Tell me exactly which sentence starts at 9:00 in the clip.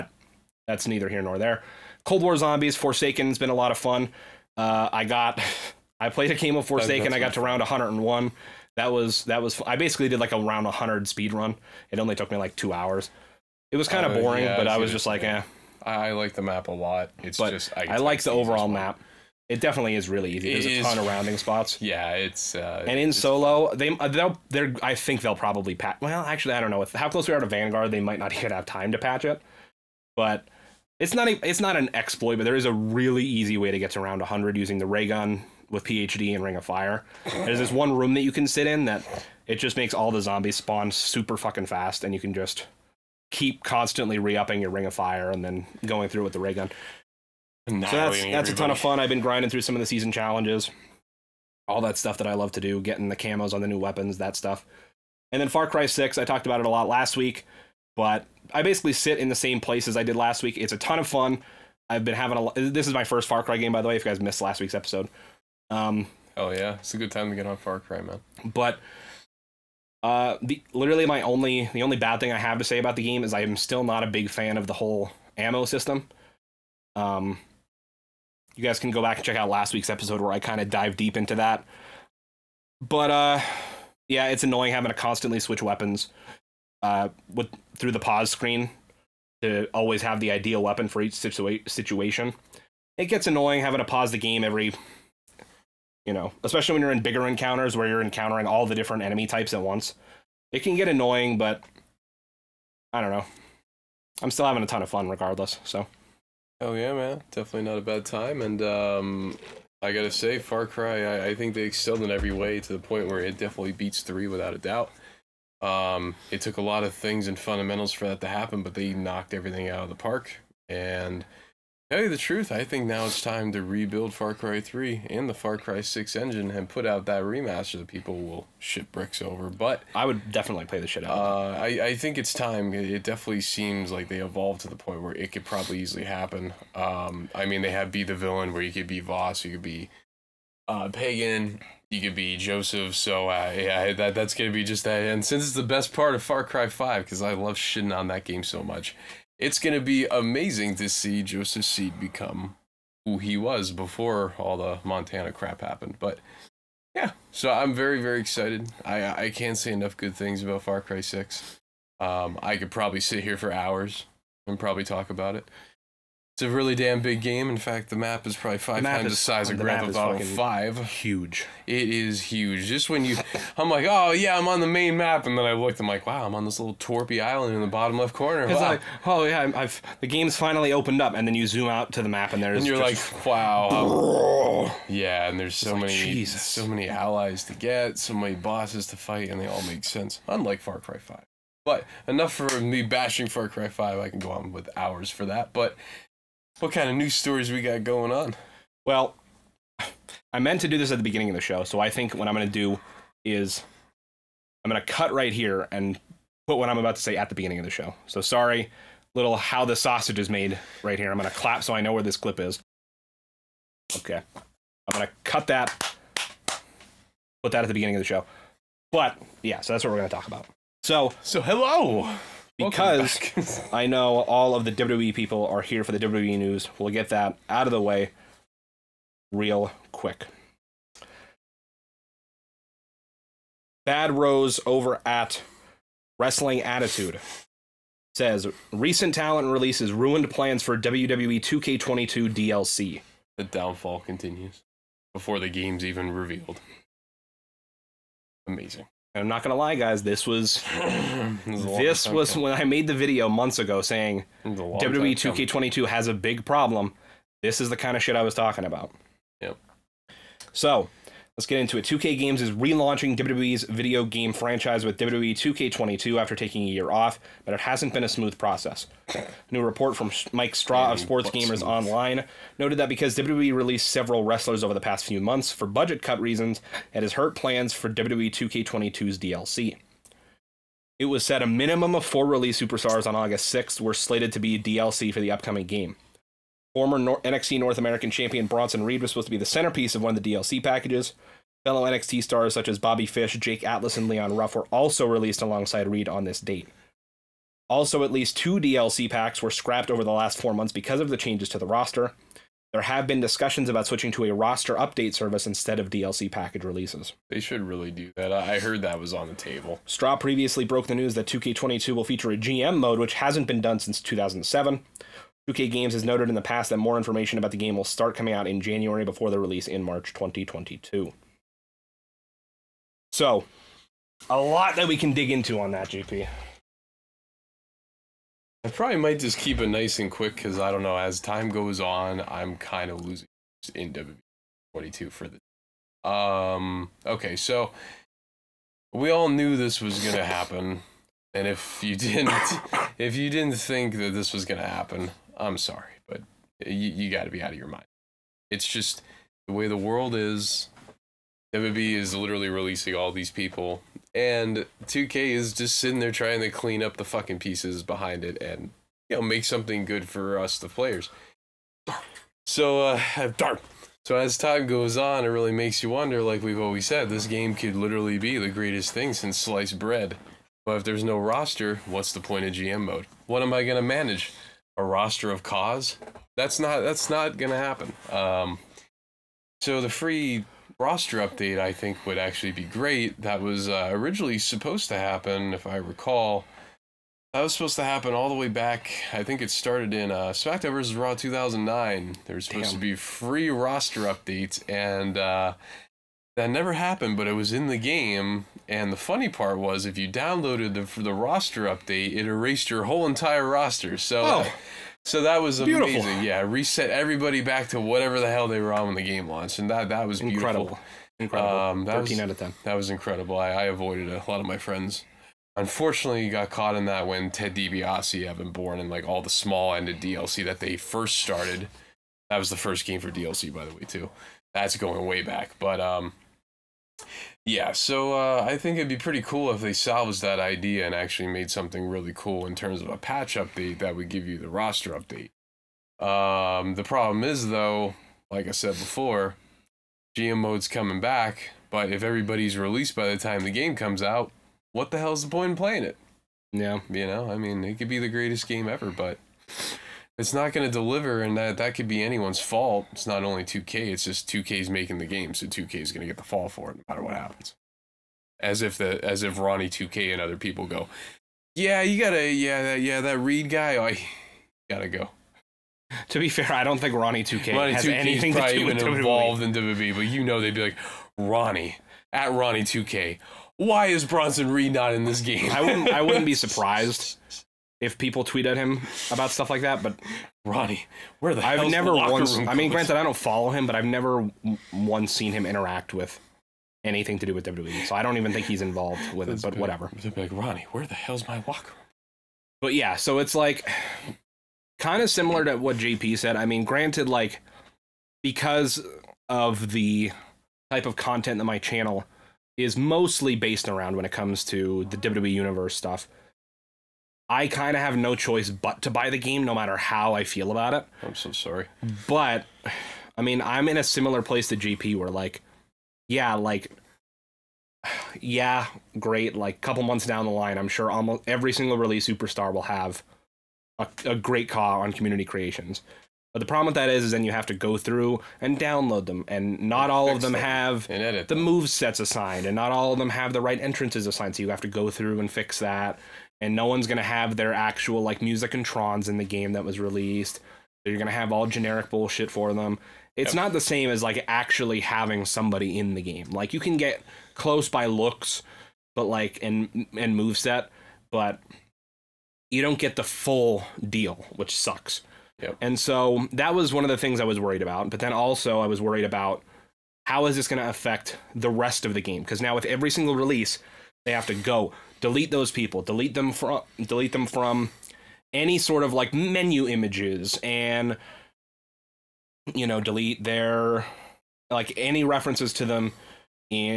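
they you're gonna have all generic bullshit for them.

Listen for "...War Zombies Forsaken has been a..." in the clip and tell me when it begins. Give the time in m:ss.
0:02.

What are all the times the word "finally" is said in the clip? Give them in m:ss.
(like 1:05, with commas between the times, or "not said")
3:00.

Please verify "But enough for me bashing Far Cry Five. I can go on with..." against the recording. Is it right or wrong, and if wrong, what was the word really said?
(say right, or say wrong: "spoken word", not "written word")
right.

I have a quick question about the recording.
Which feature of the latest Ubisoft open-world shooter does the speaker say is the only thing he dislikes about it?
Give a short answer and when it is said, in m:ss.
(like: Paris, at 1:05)
ammo system, at 1:15.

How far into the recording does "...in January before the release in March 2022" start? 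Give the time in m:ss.
5:18.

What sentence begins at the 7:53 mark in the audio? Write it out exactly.
Why is Bronson Reed not in this game?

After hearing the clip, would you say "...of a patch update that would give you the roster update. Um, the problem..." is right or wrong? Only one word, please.
right.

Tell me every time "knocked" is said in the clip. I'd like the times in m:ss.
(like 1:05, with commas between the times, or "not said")
1:58.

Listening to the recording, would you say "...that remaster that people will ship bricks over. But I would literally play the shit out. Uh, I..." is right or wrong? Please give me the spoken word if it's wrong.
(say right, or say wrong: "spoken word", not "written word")
wrong: "definitely", not "literally".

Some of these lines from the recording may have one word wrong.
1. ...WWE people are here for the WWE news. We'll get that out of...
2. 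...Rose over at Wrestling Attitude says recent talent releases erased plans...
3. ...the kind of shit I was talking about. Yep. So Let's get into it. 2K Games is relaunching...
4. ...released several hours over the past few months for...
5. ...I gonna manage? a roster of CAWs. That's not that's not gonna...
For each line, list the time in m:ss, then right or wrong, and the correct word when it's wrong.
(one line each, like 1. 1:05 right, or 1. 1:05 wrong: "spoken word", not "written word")
1. 3:44 right
2. 3:54 wrong: "ruined", not "erased"
3. 4:17 right
4. 4:33 wrong: "wrestlers", not "hours"
5. 6:13 right.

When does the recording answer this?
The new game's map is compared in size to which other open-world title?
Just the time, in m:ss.
2:49.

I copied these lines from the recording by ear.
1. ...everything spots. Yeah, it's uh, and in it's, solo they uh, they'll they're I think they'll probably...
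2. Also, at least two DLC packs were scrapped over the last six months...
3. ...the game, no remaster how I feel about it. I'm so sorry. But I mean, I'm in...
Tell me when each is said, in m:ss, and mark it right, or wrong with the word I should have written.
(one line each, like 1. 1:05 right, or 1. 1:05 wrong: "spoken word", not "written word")
1. 0:21 wrong: "rounding", not "everything"
2. 4:57 wrong: "four", not "six"
3. 8:29 wrong: "matter", not "remaster".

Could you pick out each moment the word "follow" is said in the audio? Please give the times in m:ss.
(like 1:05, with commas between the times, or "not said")
8:03.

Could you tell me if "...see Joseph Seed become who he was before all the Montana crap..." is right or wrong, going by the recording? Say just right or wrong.
right.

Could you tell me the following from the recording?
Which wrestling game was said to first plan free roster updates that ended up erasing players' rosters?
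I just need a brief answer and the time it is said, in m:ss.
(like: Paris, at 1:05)
SmackDown vs. Raw 2009, at 6:30.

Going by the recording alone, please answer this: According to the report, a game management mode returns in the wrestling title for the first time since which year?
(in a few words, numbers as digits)
2007.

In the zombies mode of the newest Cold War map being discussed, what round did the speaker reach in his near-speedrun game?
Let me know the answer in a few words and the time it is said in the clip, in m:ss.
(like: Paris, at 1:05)
101, at 0:07.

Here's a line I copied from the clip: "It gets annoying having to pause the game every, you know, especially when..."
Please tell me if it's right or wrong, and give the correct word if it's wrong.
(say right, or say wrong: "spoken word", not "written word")
right.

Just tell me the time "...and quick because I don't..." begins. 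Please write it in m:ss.
5:29.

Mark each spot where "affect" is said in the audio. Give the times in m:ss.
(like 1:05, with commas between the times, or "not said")
9:20.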